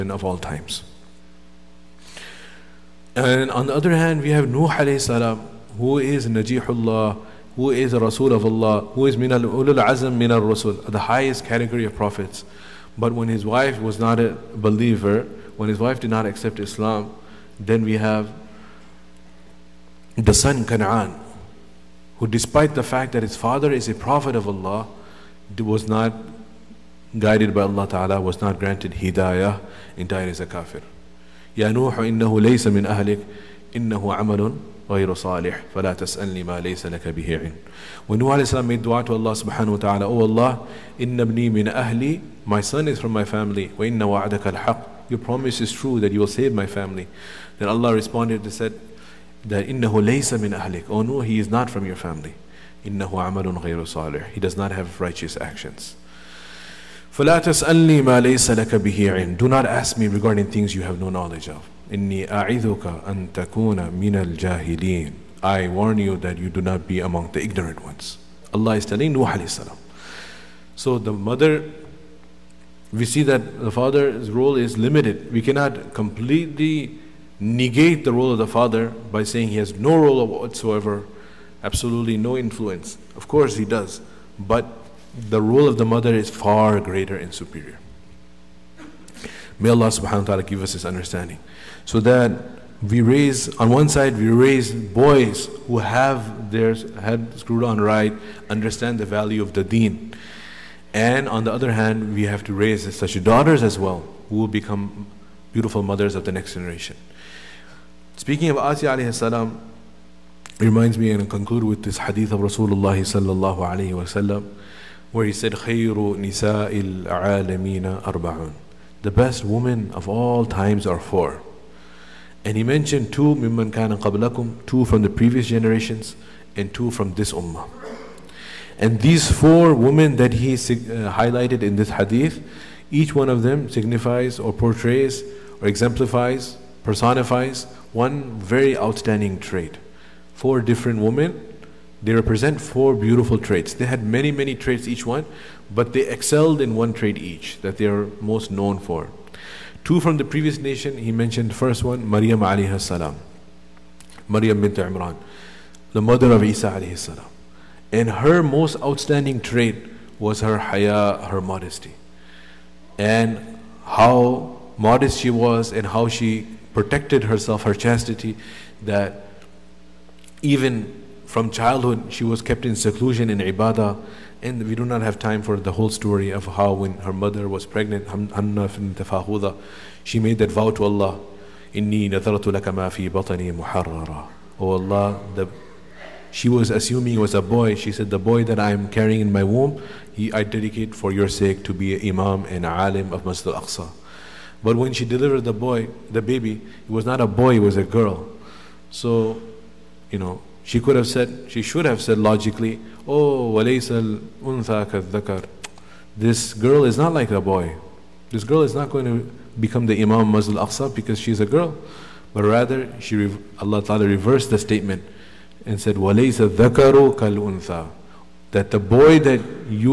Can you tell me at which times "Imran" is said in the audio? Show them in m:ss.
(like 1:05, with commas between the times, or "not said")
2:34.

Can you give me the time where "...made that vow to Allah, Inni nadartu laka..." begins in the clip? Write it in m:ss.
3:00.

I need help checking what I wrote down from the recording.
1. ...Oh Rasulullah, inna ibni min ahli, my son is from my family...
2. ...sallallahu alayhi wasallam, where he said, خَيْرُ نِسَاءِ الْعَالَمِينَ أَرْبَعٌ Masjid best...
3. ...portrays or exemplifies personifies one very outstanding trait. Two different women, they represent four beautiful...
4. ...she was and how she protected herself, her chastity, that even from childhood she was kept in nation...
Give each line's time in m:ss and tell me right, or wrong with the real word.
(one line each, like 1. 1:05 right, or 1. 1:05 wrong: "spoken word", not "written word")
1. 0:40 wrong: "Allah", not "Rasulullah"
2. 1:52 wrong: "The", not "Masjid"
3. 2:14 wrong: "Four", not "Two"
4. 2:45 wrong: "seclusion", not "nation".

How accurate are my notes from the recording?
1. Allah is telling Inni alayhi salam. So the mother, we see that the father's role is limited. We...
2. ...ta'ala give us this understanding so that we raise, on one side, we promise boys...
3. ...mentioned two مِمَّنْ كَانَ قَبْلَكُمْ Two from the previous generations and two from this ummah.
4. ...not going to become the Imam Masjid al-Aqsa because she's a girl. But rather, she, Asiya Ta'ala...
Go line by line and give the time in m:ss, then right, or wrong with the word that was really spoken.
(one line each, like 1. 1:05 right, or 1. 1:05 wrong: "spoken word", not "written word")
1. 1:08 wrong: "Nuh", not "Inni"
2. 1:30 wrong: "raise", not "promise"
3. 2:02 right
4. 3:28 wrong: "Allah", not "Asiya".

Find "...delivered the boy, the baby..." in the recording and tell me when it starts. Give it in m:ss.
3:15.